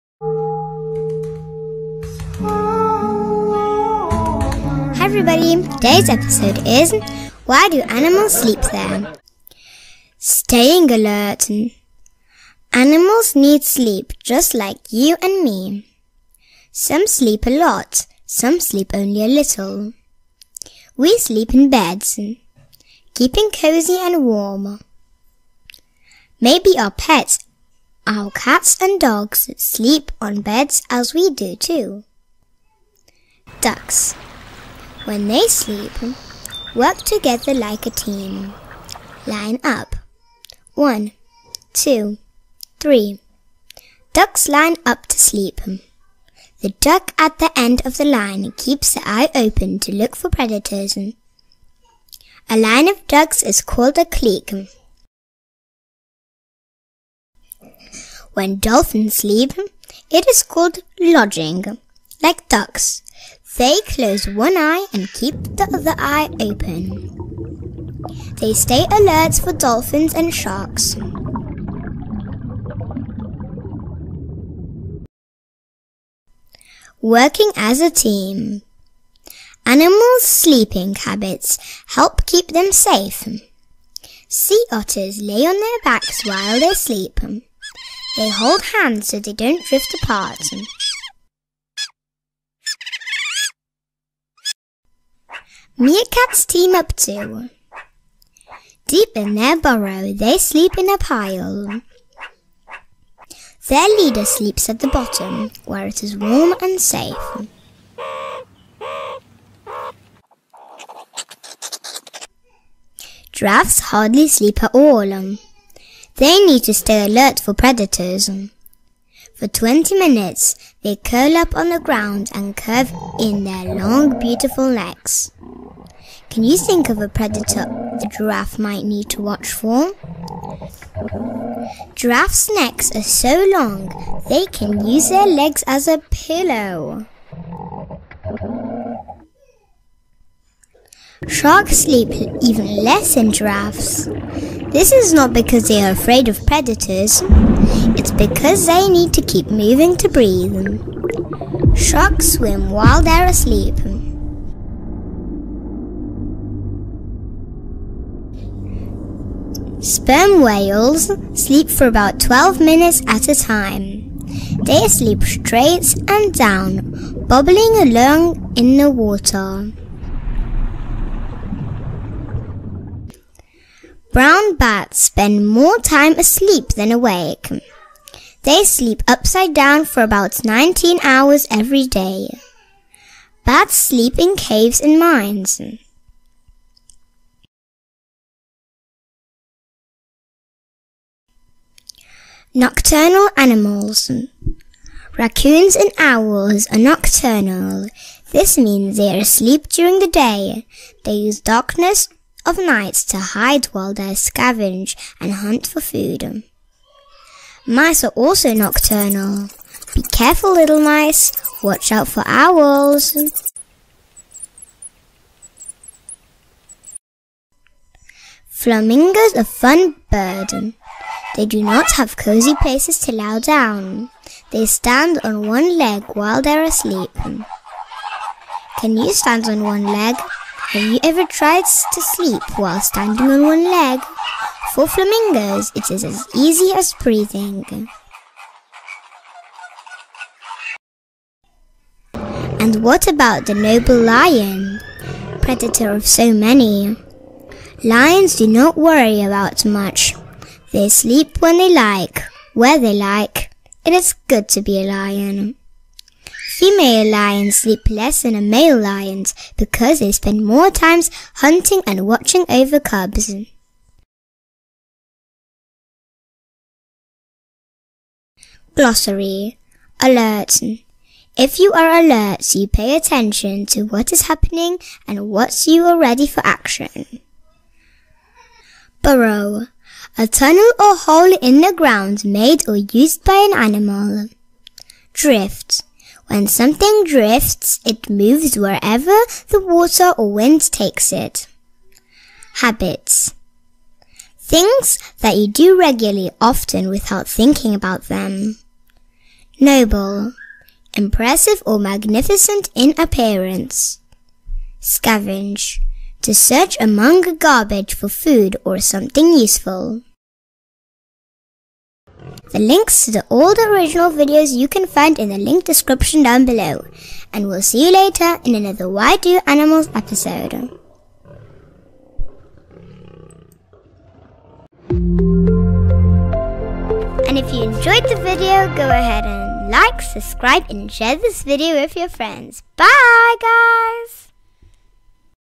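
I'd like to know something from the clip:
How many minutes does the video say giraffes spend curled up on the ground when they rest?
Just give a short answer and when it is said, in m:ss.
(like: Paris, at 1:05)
20, at 1:59.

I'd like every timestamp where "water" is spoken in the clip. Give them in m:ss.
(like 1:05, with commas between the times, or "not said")
2:48, 4:49.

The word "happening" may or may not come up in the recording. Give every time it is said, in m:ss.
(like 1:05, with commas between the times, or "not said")
4:34.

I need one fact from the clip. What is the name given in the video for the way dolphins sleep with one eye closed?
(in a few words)
Logging.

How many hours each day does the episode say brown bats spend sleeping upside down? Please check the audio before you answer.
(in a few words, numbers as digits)
19.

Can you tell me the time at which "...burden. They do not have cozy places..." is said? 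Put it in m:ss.
3:40.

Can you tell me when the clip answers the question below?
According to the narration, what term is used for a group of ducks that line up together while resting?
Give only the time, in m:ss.
0:53.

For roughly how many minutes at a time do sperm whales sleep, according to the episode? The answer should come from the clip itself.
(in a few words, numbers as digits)
12.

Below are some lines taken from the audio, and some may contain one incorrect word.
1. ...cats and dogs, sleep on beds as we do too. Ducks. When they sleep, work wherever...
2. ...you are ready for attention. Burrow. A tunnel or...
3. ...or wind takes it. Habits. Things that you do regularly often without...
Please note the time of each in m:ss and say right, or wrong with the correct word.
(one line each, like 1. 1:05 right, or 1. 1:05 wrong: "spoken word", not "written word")
1. 0:28 wrong: "together", not "wherever"
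2. 4:35 wrong: "action", not "attention"
3. 4:50 right.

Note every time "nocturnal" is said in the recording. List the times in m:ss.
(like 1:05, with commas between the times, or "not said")
3:12, 3:16, 3:28.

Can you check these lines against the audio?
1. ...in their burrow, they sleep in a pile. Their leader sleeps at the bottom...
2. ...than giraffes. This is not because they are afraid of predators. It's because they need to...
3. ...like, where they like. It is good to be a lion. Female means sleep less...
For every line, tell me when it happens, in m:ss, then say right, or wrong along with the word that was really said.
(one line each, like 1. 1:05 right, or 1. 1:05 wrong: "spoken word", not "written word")
1. 1:39 right
2. 2:23 right
3. 4:11 wrong: "lions", not "means".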